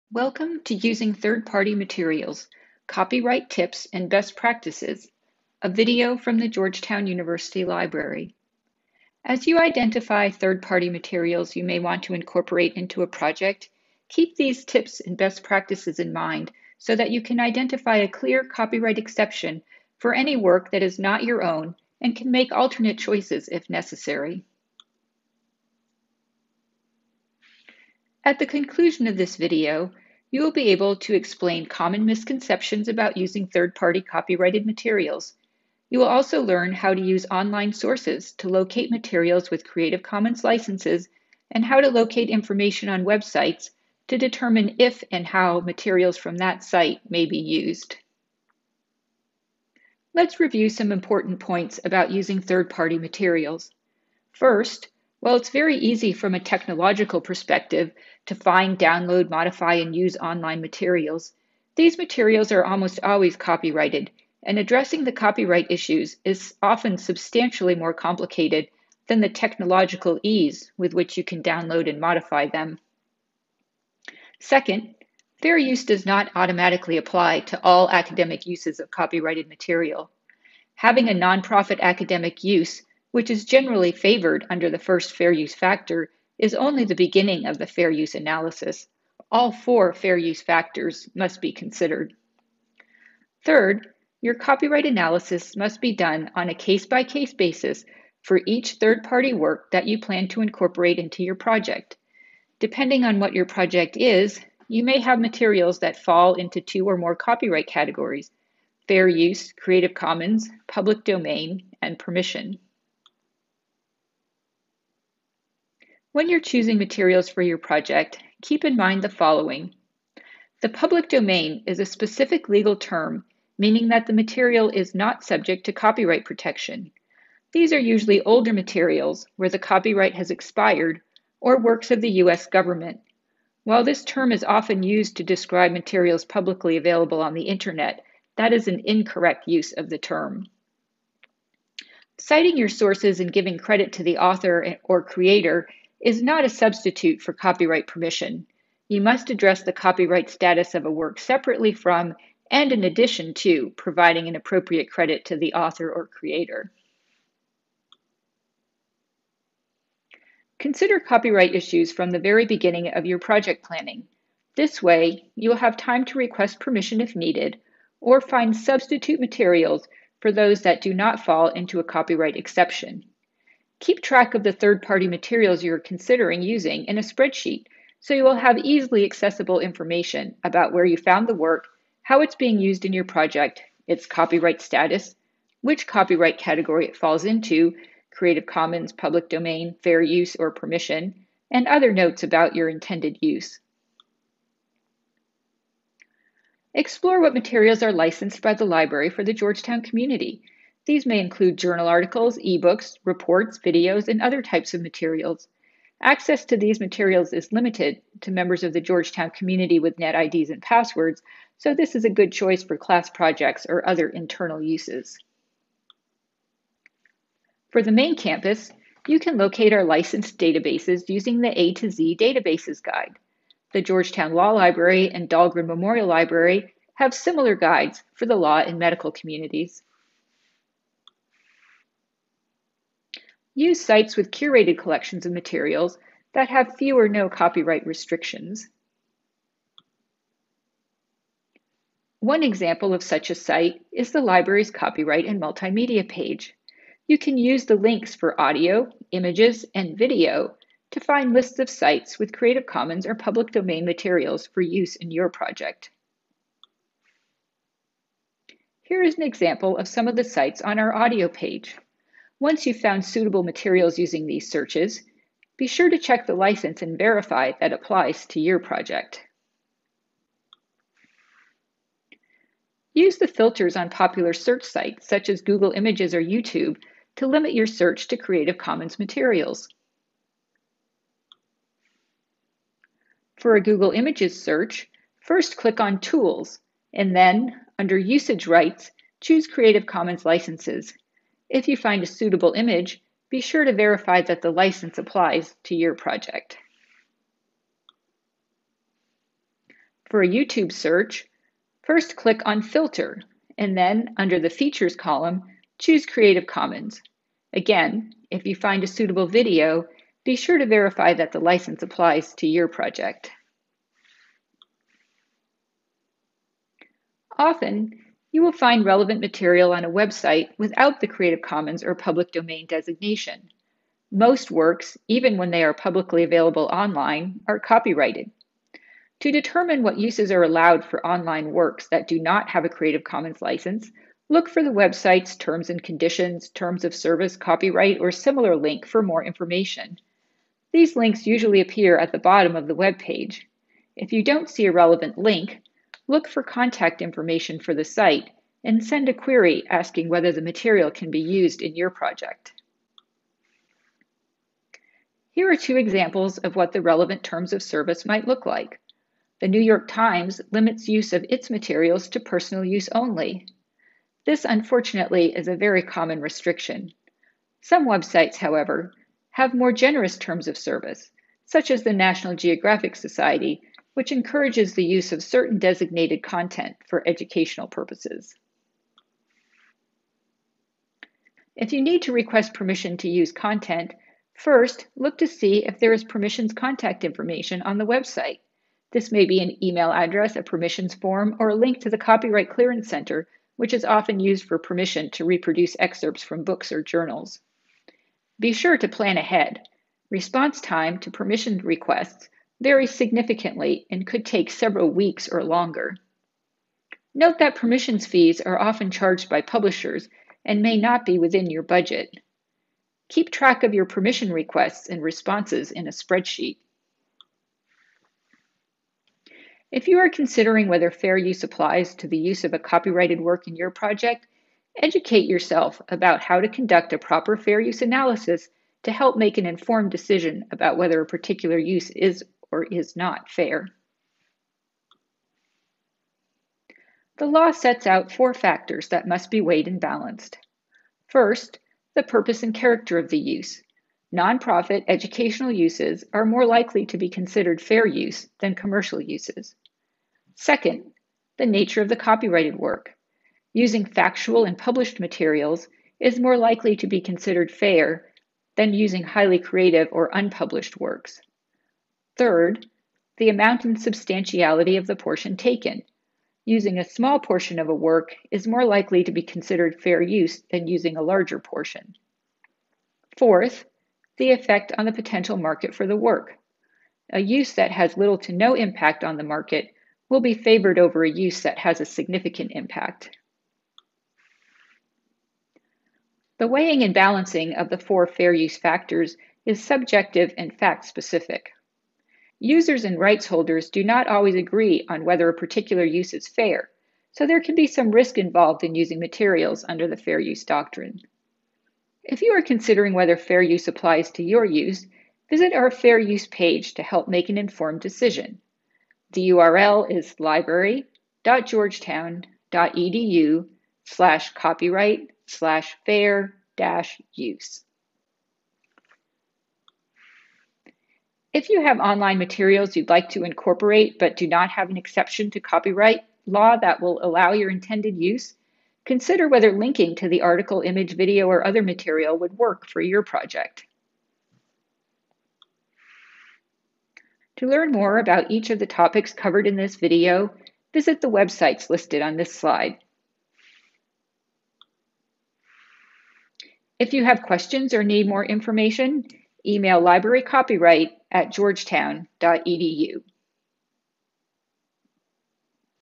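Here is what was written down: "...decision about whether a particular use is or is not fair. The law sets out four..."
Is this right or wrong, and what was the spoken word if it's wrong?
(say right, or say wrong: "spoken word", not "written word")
right.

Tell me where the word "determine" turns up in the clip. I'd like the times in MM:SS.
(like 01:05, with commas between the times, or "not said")
00:44, 05:29.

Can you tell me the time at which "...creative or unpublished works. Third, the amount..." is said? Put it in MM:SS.
07:39.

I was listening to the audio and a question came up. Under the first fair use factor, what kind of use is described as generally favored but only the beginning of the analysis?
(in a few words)
nonprofit academic use.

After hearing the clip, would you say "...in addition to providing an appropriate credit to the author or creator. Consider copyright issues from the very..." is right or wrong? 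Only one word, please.
right.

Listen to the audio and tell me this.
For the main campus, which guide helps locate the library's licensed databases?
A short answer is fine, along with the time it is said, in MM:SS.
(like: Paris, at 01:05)
A to Z Databases Guide, at 03:41.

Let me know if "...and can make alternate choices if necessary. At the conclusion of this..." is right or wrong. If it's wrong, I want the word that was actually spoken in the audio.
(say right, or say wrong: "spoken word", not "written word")
right.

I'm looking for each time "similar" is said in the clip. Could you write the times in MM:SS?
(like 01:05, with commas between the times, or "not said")
03:47, 05:38.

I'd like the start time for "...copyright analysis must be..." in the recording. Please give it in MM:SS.
01:34.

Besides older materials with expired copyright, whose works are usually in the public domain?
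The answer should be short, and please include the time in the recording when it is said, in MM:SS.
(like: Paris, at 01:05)
U.S. government, at 02:12.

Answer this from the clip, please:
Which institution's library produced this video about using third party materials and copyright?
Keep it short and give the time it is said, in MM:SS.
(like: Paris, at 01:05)
Georgetown University, at 00:06.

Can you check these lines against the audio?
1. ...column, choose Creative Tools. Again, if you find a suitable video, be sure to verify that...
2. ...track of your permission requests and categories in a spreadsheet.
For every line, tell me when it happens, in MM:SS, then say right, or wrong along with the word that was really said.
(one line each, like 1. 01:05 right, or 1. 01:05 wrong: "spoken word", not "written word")
1. 05:04 wrong: "Commons", not "Tools"
2. 06:53 wrong: "responses", not "categories".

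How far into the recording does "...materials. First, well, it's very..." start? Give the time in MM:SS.
00:52.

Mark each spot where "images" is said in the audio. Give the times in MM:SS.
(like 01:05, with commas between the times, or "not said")
04:09, 04:35, 04:43, 04:52, 08:50.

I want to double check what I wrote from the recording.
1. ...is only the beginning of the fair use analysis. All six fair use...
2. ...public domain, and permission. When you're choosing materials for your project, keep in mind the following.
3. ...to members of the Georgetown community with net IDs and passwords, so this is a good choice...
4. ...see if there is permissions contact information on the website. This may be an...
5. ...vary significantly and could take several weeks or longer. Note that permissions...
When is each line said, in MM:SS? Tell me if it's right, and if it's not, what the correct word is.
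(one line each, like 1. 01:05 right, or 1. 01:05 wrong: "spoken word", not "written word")
1. 01:26 wrong: "four", not "six"
2. 01:50 right
3. 03:28 right
4. 06:25 right
5. 06:42 right.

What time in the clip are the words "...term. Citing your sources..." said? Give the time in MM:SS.
02:19.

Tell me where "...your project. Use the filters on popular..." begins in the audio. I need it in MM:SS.
04:28.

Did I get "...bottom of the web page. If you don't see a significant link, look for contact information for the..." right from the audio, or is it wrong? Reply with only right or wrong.
wrong.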